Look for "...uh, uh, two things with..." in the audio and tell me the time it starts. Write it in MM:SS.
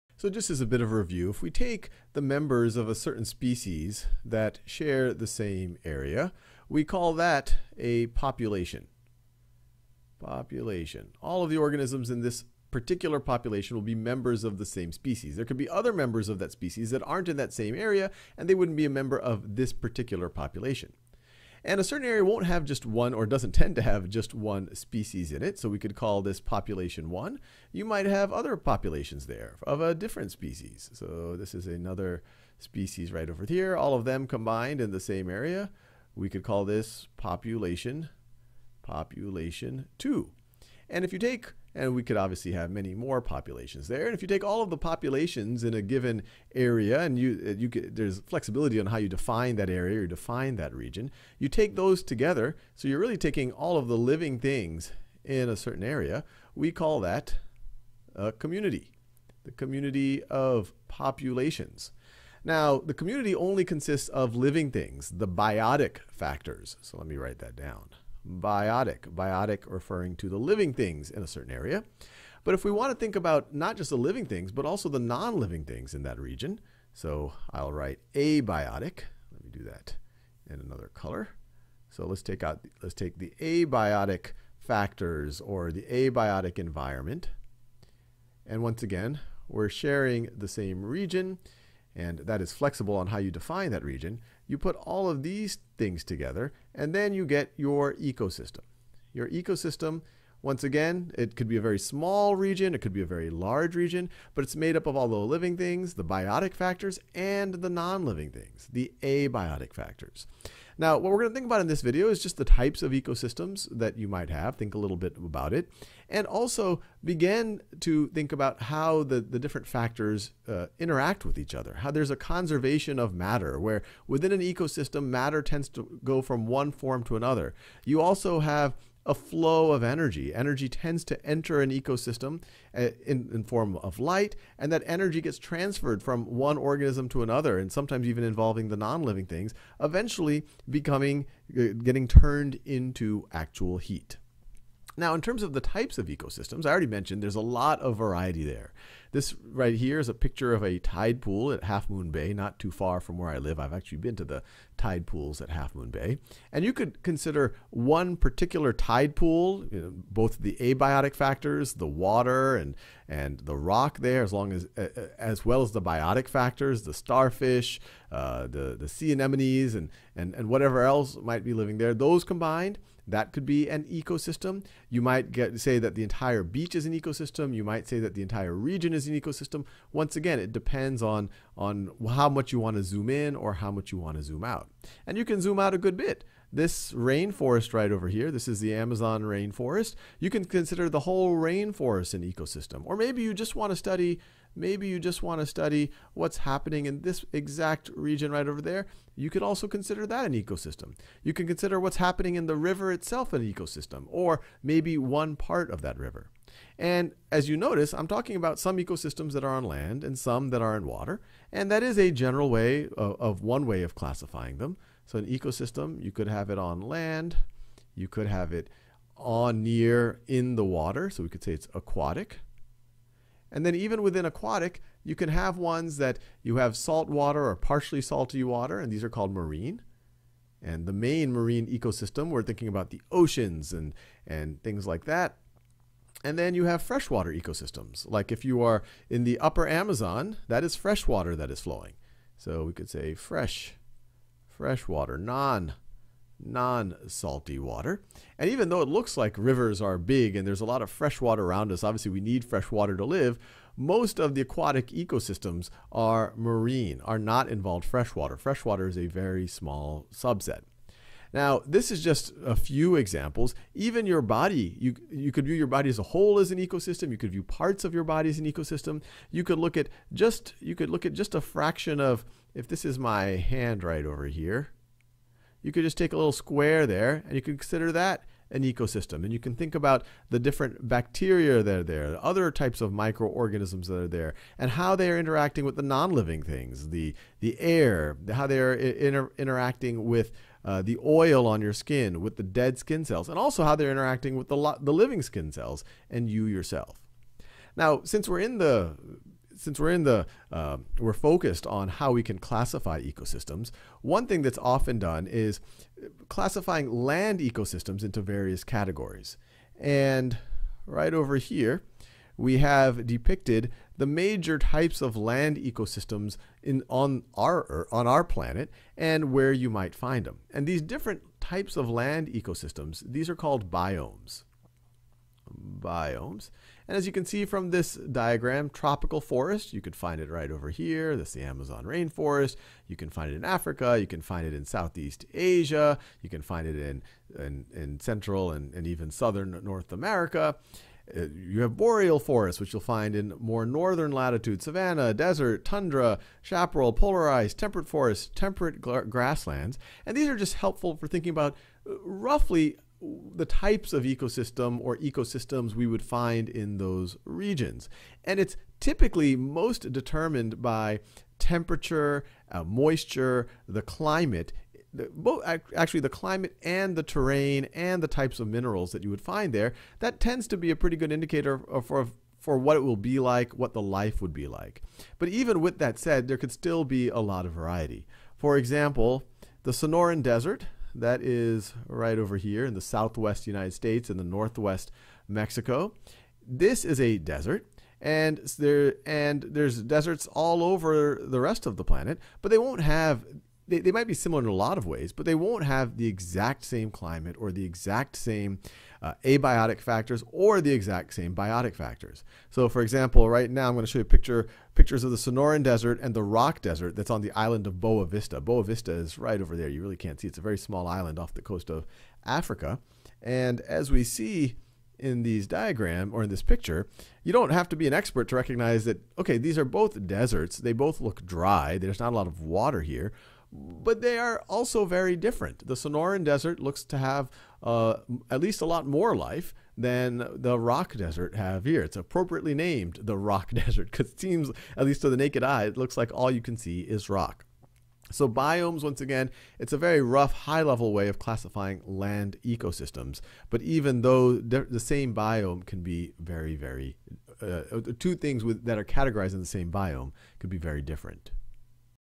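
07:27.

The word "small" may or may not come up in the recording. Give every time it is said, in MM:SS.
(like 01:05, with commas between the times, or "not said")
01:41, 04:19, 06:50.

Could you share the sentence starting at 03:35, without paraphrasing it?
So an ecosystem, you could have it on land, you could have it on, near, in the water.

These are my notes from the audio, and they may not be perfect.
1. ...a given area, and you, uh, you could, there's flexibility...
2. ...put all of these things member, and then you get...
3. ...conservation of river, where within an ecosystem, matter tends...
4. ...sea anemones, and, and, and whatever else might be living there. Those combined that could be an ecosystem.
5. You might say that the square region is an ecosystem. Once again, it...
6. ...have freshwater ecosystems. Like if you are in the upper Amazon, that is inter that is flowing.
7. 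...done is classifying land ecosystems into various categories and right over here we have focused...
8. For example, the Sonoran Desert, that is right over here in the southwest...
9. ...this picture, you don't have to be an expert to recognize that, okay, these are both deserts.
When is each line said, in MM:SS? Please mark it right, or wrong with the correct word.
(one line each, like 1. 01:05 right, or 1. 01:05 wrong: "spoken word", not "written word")
1. 00:45 right
2. 01:34 wrong: "together", not "member"
3. 02:02 wrong: "matter", not "river"
4. 02:48 right
5. 02:57 wrong: "entire", not "square"
6. 03:56 wrong: "freshwater", not "inter"
7. 05:04 wrong: "depicted", not "focused"
8. 06:18 right
9. 06:56 right.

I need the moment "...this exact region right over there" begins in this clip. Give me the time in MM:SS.
03:17.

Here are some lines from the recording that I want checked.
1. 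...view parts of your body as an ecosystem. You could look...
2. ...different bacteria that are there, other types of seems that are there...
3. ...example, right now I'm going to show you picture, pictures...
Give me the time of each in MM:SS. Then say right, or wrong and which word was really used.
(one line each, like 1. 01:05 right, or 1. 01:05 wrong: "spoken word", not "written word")
1. 04:27 right
2. 04:40 wrong: "microorganisms", not "seems"
3. 06:42 right.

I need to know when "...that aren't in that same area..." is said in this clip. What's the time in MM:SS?
00:16.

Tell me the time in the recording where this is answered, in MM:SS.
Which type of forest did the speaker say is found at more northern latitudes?
05:41.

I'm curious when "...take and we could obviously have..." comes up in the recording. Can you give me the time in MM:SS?
00:41.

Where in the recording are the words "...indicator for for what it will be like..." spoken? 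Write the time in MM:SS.
06:11.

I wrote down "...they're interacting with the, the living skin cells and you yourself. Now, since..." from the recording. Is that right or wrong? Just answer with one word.
right.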